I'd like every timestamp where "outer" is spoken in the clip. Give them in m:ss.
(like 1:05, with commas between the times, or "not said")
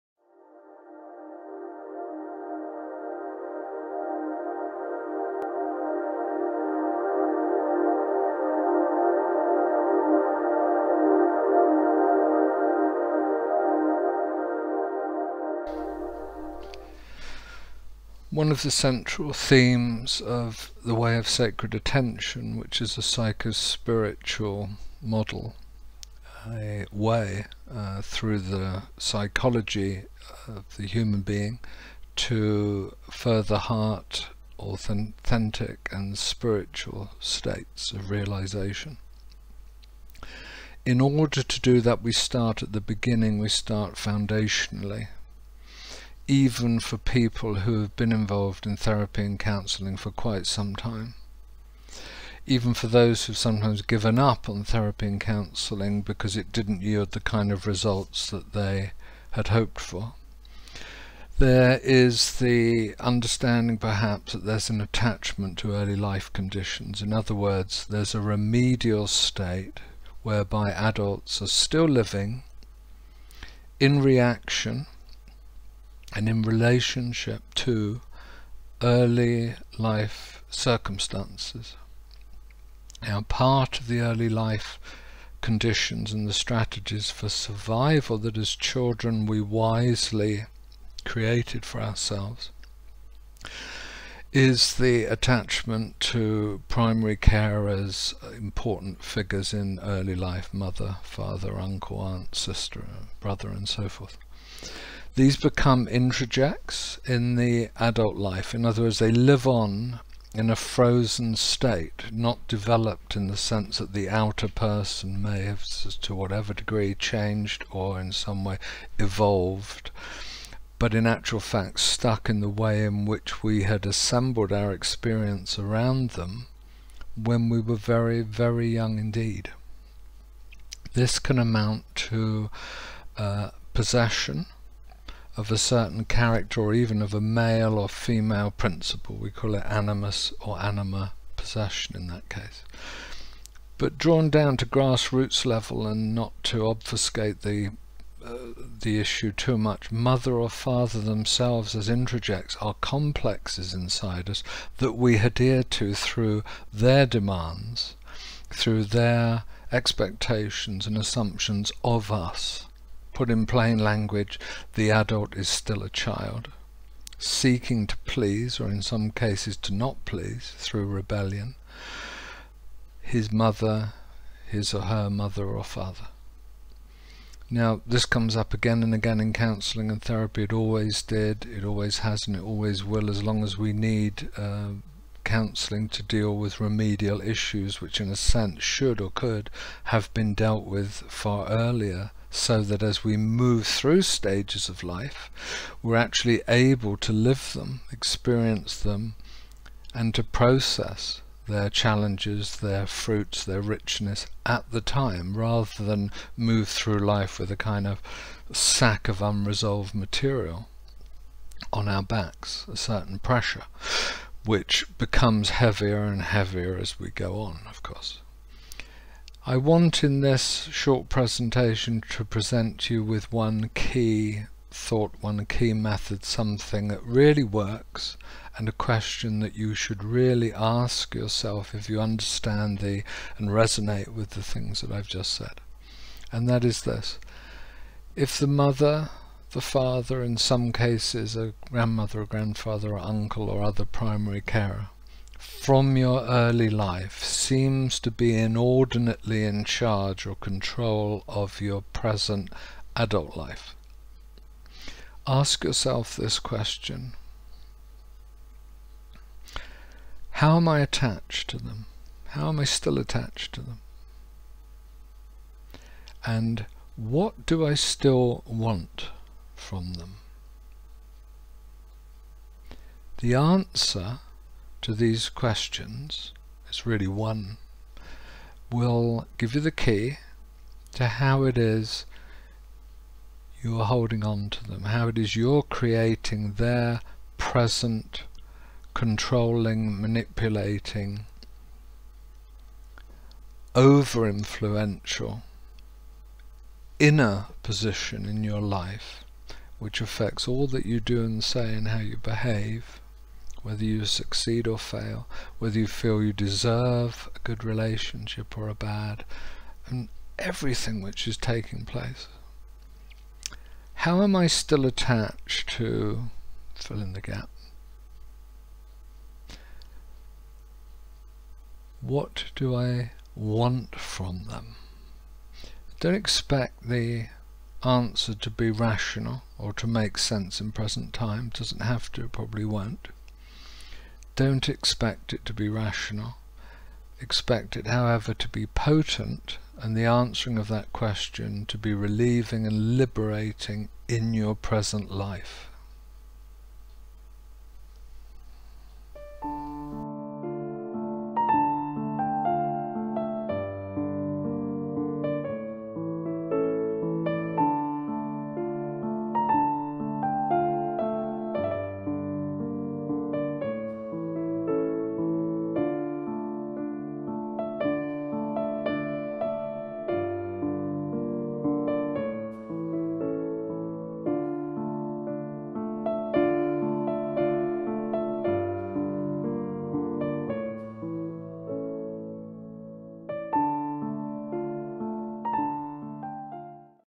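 1:54.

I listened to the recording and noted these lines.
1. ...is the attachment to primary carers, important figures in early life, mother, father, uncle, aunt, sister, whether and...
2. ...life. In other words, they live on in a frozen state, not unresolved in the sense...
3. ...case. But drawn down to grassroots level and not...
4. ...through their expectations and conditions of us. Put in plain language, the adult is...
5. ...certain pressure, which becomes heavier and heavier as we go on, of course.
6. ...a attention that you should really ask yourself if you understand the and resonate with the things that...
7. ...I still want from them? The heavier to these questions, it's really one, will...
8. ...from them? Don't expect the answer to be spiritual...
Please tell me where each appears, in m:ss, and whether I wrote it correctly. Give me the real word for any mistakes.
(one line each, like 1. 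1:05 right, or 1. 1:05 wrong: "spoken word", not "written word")
1. 1:34 wrong: "brother", not "whether"
2. 1:48 wrong: "developed", not "unresolved"
3. 2:22 right
4. 2:38 wrong: "assumptions", not "conditions"
5. 3:32 right
6. 3:48 wrong: "question", not "attention"
7. 4:27 wrong: "answer", not "heavier"
8. 5:23 wrong: "rational", not "spiritual".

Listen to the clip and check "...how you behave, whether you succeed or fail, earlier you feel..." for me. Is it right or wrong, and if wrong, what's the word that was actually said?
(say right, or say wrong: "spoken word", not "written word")
wrong: "whether", not "earlier".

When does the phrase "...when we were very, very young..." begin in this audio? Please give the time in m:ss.
2:07.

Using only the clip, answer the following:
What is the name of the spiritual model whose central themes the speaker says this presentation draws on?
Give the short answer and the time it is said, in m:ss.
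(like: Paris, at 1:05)
The Way of Sacred Attention, at 0:20.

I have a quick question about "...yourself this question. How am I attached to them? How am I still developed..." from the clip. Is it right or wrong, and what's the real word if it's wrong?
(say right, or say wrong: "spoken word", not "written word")
wrong: "attached", not "developed".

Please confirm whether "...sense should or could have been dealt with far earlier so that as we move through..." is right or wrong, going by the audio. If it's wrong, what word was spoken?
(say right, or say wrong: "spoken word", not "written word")
right.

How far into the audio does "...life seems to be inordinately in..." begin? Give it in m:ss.
4:06.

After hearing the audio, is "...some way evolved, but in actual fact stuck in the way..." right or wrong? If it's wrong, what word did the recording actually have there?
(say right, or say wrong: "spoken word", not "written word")
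right.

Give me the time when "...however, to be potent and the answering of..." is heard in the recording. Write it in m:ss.
5:37.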